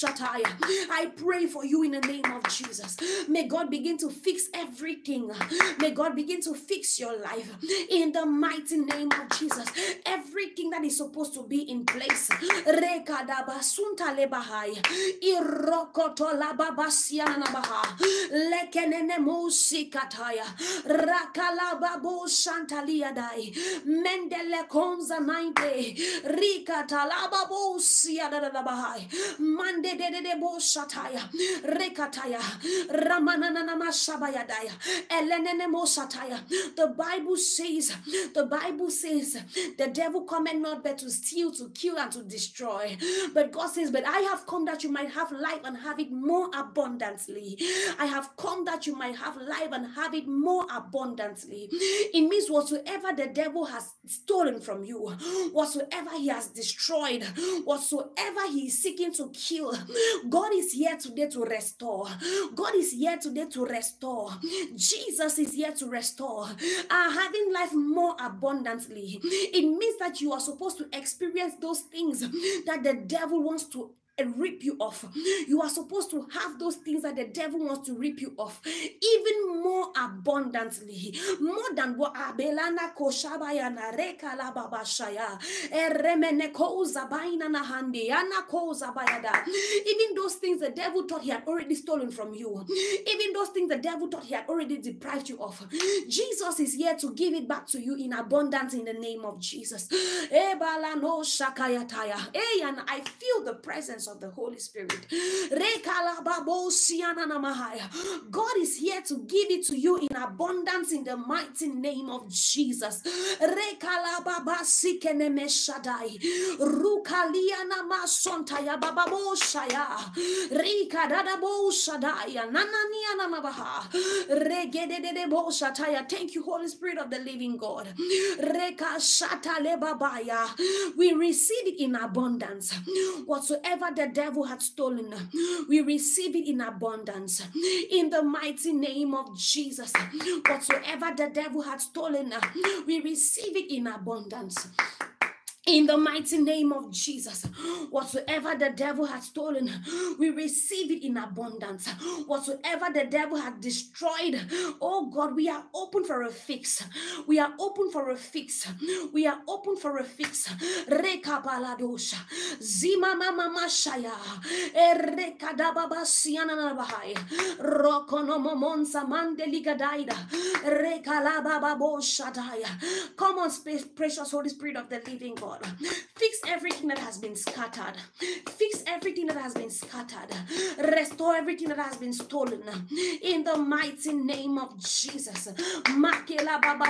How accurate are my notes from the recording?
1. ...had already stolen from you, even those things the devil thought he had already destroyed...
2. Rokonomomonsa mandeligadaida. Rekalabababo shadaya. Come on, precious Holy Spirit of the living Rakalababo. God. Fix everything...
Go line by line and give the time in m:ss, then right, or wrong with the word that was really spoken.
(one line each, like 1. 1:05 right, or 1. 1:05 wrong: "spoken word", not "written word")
1. 1:31 wrong: "deprived", not "destroyed"
2. 2:47 wrong: "God", not "Rakalababo".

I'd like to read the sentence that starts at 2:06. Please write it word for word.
Thank you, Holy Spirit of the living God.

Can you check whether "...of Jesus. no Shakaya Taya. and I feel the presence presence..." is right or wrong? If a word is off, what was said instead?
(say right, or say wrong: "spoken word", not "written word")
right.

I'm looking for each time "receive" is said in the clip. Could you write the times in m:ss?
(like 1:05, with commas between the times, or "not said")
2:11, 2:15, 2:23, 2:30.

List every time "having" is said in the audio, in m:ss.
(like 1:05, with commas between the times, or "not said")
1:07.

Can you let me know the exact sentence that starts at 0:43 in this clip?
But God says, But I have come that you might have life and have it more abundantly.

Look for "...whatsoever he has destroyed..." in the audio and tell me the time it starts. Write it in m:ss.
0:55.